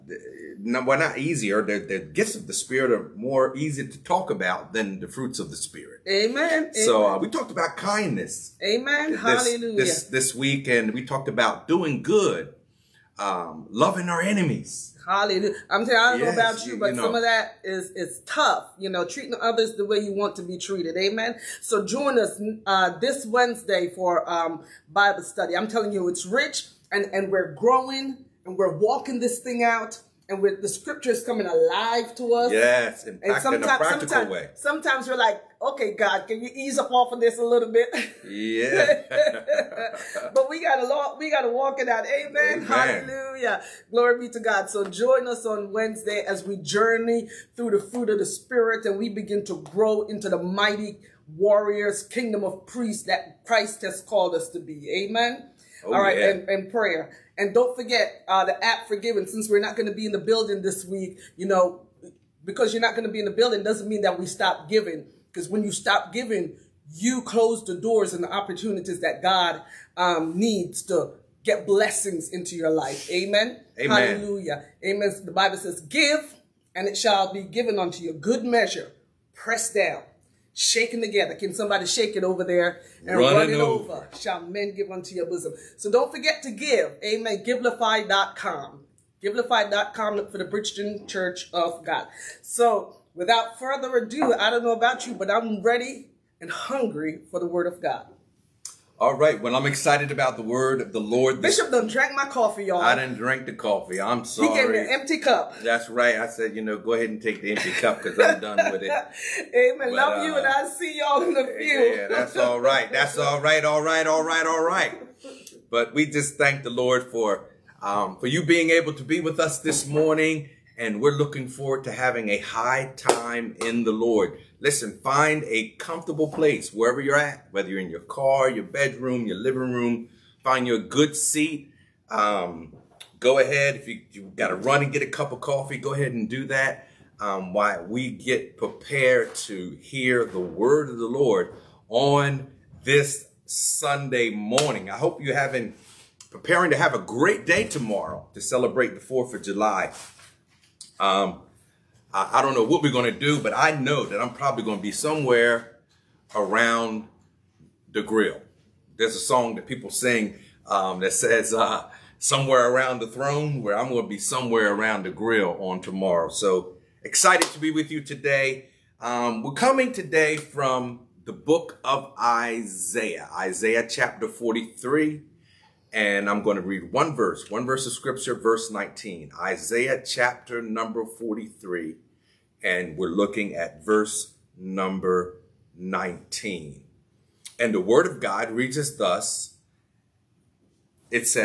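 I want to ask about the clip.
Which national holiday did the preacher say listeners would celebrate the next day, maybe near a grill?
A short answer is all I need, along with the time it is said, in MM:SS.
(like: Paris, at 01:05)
4th of July, at 02:29.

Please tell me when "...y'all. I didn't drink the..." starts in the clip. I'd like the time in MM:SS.
01:42.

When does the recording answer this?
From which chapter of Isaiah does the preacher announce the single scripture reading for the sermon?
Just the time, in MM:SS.
02:53.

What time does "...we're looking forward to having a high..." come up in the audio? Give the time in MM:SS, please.
02:01.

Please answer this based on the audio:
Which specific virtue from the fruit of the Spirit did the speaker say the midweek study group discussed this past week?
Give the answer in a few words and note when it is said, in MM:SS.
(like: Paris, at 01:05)
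Kindness, at 00:07.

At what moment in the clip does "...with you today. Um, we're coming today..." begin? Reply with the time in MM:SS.
02:47.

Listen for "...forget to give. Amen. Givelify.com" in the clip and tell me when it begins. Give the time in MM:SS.
01:26.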